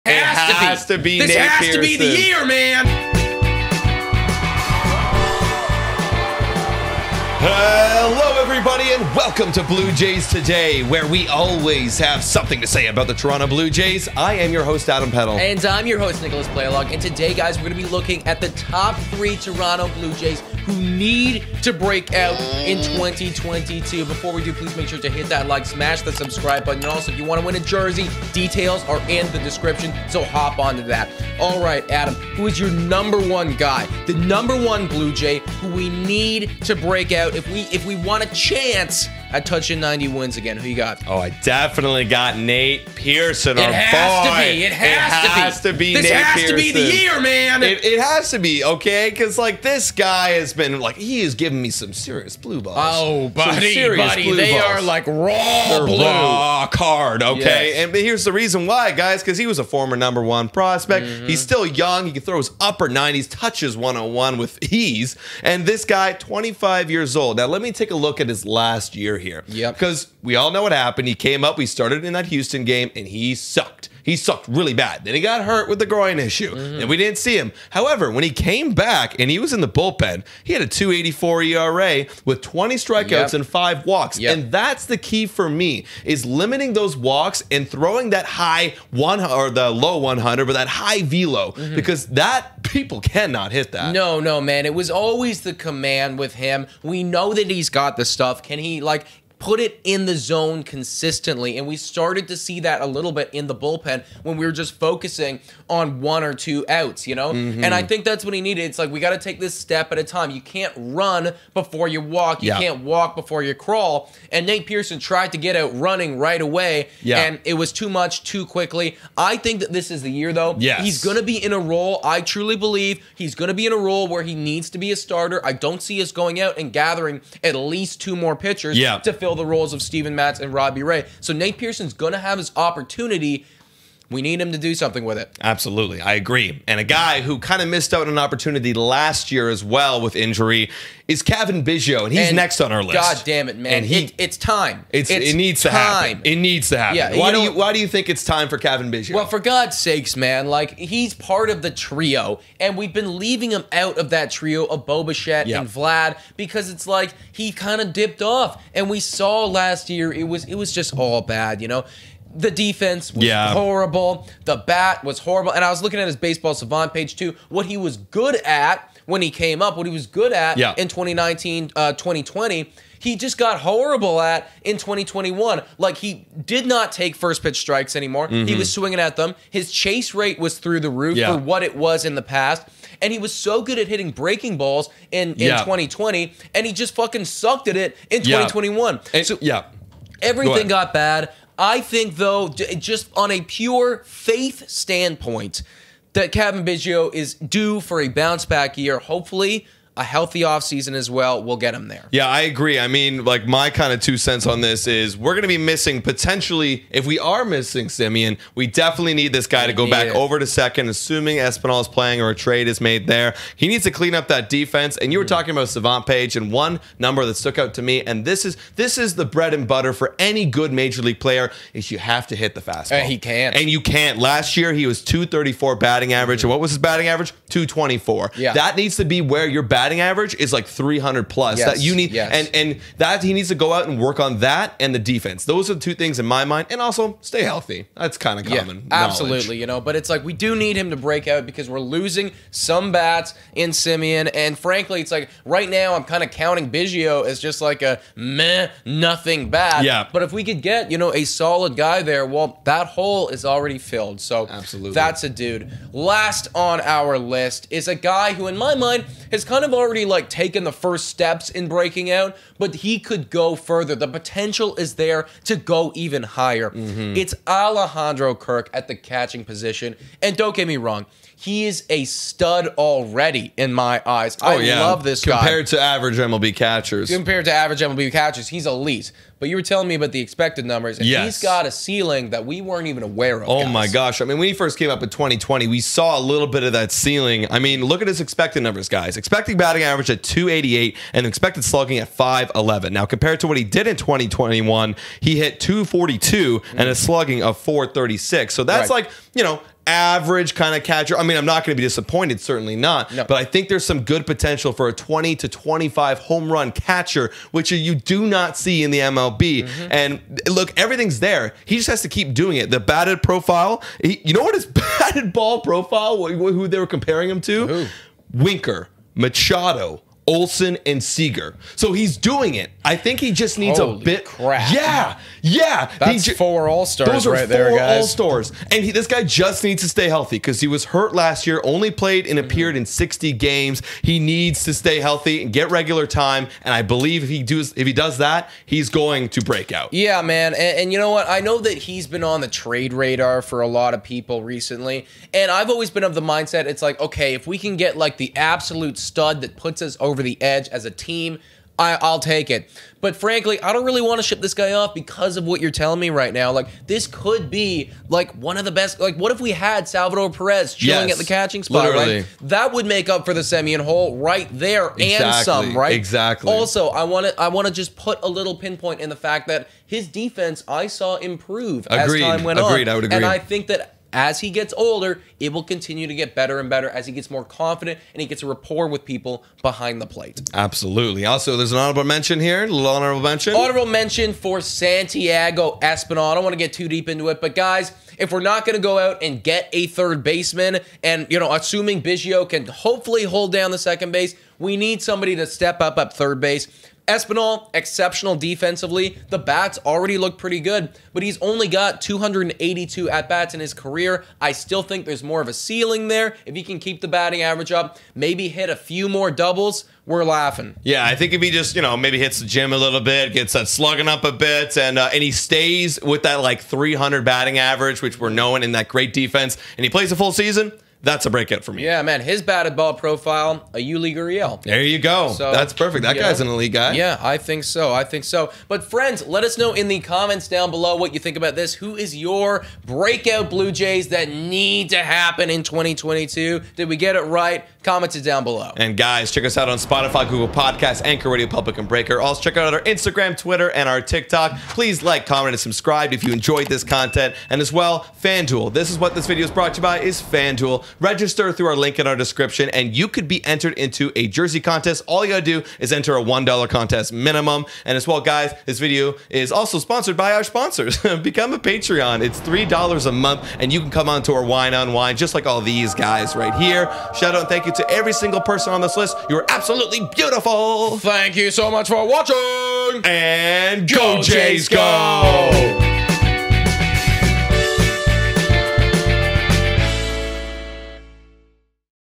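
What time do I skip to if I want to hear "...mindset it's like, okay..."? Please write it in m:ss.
5:46.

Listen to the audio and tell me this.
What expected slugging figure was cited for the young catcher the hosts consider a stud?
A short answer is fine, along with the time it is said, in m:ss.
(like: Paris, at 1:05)
511, at 4:52.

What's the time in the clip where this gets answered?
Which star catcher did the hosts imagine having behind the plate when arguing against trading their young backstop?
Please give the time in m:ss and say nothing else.
5:59.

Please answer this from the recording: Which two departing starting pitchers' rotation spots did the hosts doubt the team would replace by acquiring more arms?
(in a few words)
Steven Matz and Robbie Ray.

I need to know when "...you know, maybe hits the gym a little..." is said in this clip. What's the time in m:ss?
6:51.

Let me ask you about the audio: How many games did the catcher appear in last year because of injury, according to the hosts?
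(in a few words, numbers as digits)
60.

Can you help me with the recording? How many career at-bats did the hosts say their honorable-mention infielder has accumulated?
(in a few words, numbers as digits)
282.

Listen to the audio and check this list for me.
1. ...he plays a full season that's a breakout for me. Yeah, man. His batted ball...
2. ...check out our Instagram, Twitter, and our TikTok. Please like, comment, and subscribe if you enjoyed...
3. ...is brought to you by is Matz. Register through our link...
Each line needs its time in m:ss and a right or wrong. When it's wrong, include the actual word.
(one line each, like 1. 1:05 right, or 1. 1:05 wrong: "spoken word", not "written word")
1. 6:59 right
2. 7:22 right
3. 7:29 wrong: "FanDuel", not "Matz".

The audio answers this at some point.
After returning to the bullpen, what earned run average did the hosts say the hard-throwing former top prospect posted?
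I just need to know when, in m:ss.
1:20.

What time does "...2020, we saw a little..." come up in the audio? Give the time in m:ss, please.
4:45.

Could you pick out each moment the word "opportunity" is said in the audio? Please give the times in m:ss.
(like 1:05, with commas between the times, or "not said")
2:12, 2:18.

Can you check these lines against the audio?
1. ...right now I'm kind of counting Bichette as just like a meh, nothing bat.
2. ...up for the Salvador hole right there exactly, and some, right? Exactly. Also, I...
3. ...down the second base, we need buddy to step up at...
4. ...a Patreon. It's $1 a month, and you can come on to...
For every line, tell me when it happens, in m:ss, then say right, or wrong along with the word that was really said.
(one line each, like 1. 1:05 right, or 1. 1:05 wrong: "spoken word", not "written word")
1. 4:05 wrong: "Biggio", not "Bichette"
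2. 6:03 wrong: "Semien", not "Salvador"
3. 6:33 wrong: "somebody", not "buddy"
4. 7:41 wrong: "3", not "1".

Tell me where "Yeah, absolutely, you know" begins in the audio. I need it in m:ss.
3:58.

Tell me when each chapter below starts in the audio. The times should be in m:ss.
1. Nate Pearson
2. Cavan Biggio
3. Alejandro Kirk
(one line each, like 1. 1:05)
1. 0:40
2. 2:16
3. 4:16.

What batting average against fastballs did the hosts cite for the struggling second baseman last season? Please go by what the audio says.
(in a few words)
224.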